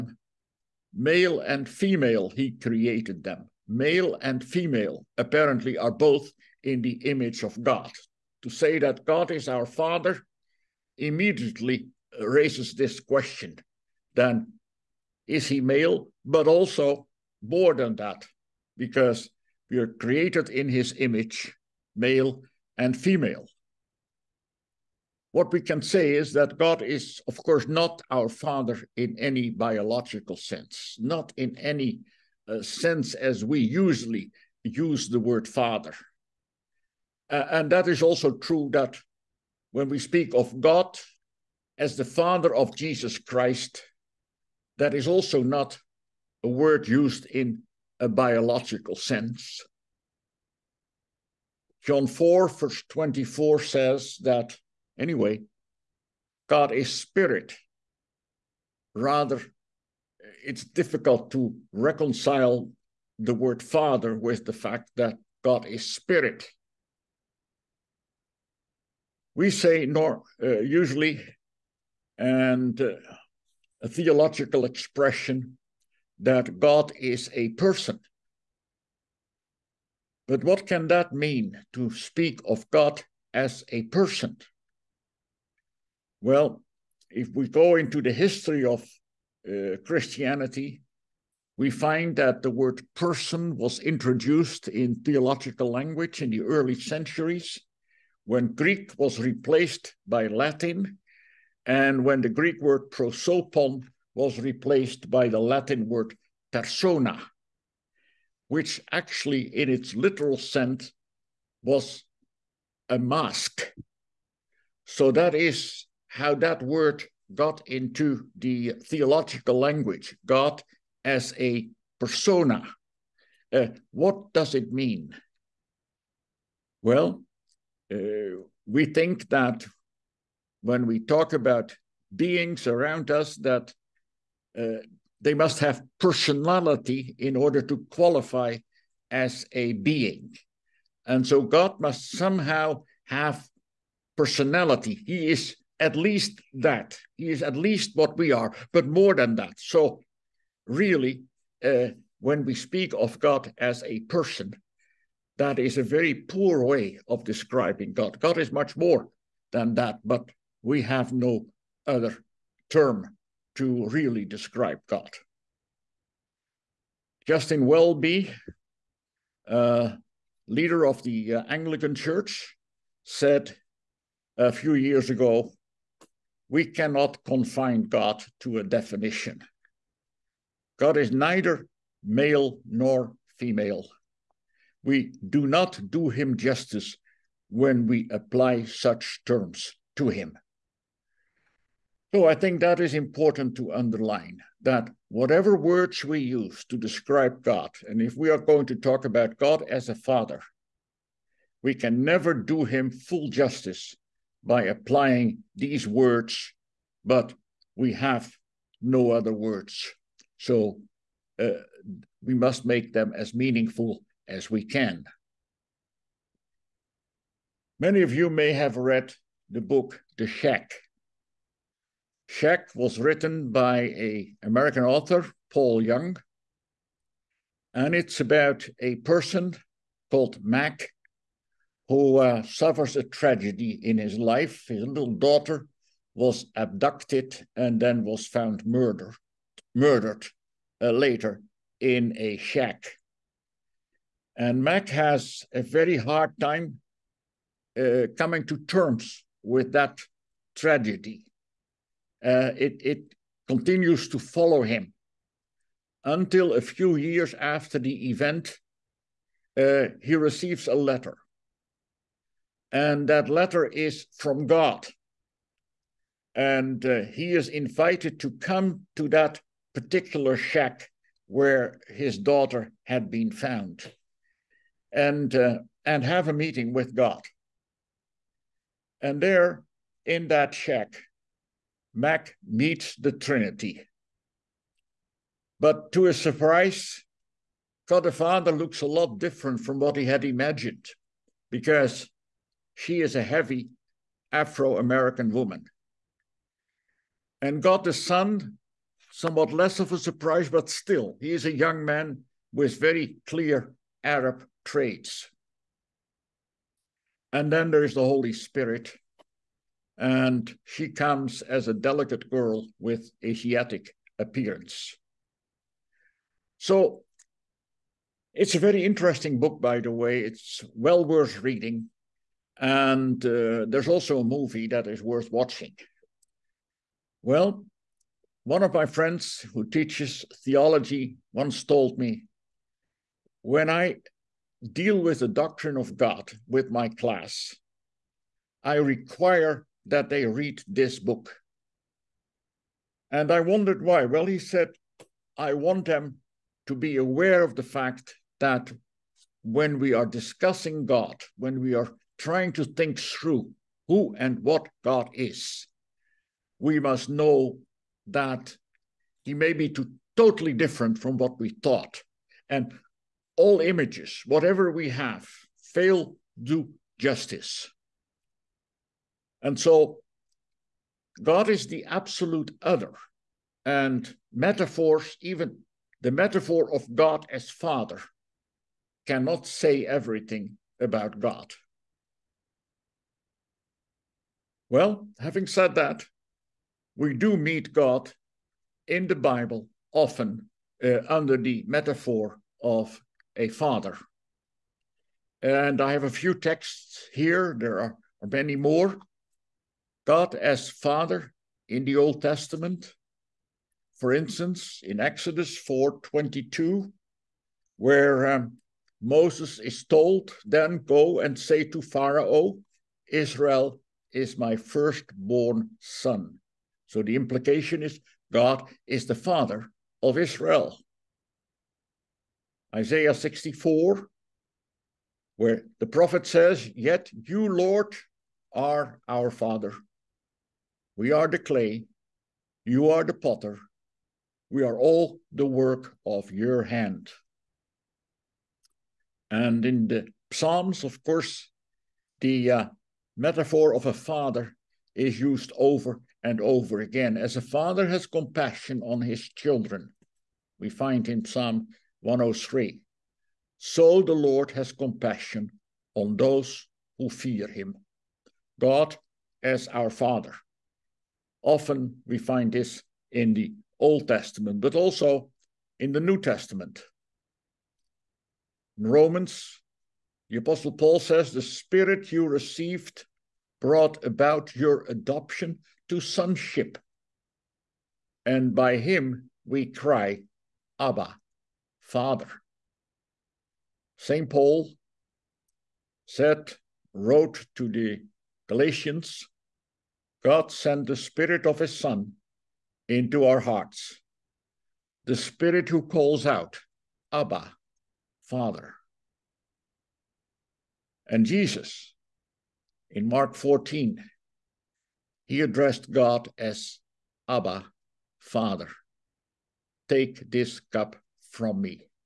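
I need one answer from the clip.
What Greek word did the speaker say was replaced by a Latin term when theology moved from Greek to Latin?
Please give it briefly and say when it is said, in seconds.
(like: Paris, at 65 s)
prosopon, at 102 s.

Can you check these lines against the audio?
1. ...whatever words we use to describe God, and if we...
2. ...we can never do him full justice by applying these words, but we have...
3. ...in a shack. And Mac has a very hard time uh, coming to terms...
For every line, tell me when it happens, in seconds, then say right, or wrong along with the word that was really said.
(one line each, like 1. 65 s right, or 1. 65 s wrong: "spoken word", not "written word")
1. 195 s right
2. 201 s right
3. 241 s right.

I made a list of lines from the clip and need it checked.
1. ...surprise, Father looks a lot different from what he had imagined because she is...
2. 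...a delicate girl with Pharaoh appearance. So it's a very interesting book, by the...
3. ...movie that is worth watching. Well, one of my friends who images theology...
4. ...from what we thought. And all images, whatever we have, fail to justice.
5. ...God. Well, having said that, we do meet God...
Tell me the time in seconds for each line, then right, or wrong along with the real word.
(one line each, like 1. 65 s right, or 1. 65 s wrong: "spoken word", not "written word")
1. 286 s right
2. 311 s wrong: "Asiatic", not "Pharaoh"
3. 324 s wrong: "teaches", not "images"
4. 360 s right
5. 381 s right.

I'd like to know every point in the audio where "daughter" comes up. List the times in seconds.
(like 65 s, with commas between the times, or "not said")
235 s, 272 s.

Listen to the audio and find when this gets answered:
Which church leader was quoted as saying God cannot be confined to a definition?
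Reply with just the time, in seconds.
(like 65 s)
167 s.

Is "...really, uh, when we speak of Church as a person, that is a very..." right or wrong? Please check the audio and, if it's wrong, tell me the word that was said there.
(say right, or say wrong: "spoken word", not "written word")
wrong: "God", not "Church".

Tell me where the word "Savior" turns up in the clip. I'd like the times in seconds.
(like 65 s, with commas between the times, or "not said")
not said.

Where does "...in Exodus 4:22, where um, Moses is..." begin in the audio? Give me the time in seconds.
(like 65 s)
404 s.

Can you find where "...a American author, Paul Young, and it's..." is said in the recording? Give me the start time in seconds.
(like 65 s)
223 s.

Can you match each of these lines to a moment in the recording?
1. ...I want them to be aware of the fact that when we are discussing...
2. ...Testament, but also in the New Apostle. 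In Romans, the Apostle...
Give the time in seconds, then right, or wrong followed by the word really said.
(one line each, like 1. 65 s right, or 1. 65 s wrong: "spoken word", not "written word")
1. 345 s right
2. 464 s wrong: "Testament", not "Apostle".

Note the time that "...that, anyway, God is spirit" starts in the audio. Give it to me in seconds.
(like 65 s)
54 s.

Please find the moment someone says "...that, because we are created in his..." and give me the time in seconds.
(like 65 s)
17 s.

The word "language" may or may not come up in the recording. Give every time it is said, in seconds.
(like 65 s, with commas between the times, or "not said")
95 s, 119 s.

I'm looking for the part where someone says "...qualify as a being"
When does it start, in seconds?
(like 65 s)
137 s.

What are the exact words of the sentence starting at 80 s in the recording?
But what can that mean to speak of God as a person?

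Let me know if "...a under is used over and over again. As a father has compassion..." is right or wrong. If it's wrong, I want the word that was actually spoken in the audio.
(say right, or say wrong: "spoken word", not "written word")
wrong: "father", not "under".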